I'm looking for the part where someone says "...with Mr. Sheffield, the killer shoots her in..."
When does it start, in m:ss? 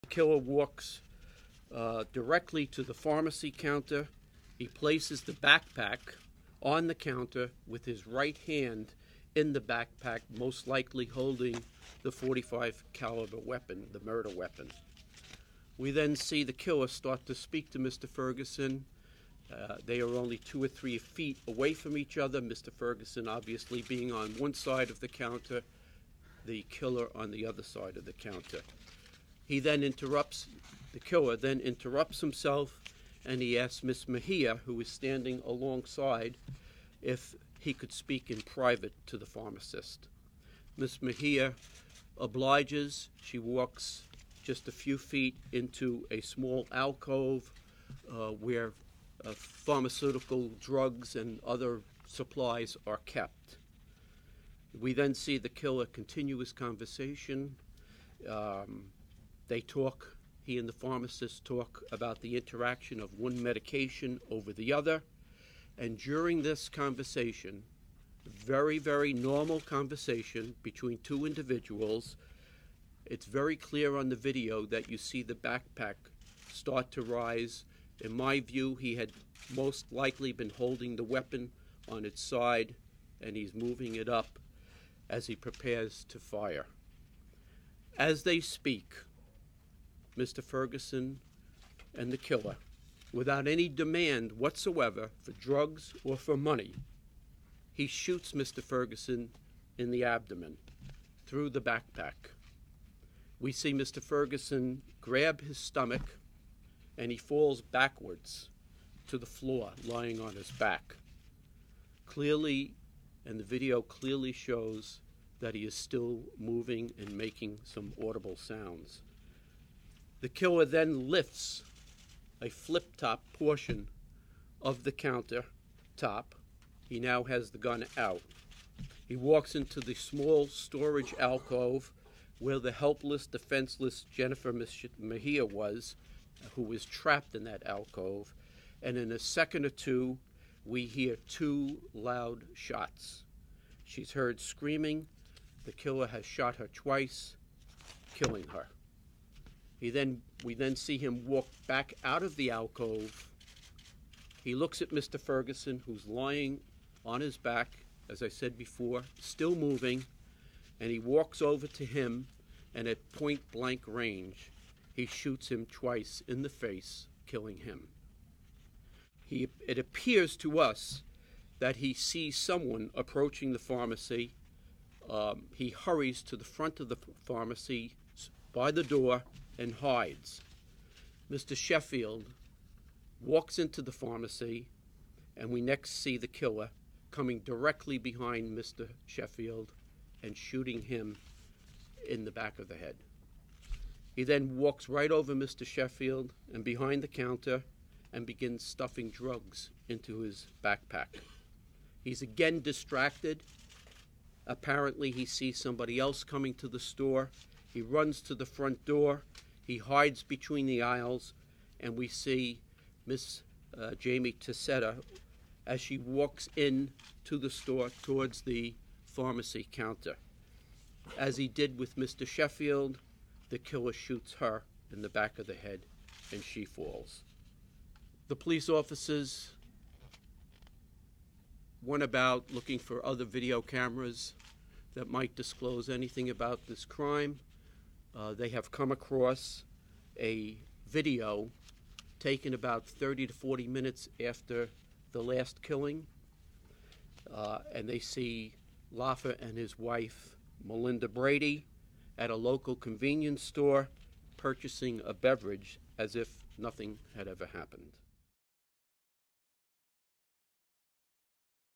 3:41.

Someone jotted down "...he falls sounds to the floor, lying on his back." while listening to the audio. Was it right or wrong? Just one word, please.
wrong.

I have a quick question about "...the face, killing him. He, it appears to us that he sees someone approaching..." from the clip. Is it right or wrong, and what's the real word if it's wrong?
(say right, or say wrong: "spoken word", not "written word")
right.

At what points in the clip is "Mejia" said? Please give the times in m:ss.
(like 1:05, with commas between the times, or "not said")
0:34, 0:41, 2:14.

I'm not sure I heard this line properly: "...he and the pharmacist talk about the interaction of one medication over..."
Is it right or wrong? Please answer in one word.
right.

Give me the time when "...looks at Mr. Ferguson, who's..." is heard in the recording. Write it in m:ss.
2:34.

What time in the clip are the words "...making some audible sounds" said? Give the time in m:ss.
1:57.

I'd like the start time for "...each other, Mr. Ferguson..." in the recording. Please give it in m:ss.
0:21.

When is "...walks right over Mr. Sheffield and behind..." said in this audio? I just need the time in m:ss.
3:14.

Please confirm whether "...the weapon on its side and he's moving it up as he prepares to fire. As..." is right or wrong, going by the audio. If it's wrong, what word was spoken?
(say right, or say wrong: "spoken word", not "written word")
right.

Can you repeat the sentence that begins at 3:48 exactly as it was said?
The police officers went about looking for other video cameras that might disclose anything about this crime.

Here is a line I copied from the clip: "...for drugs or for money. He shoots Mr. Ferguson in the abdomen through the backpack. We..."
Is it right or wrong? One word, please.
right.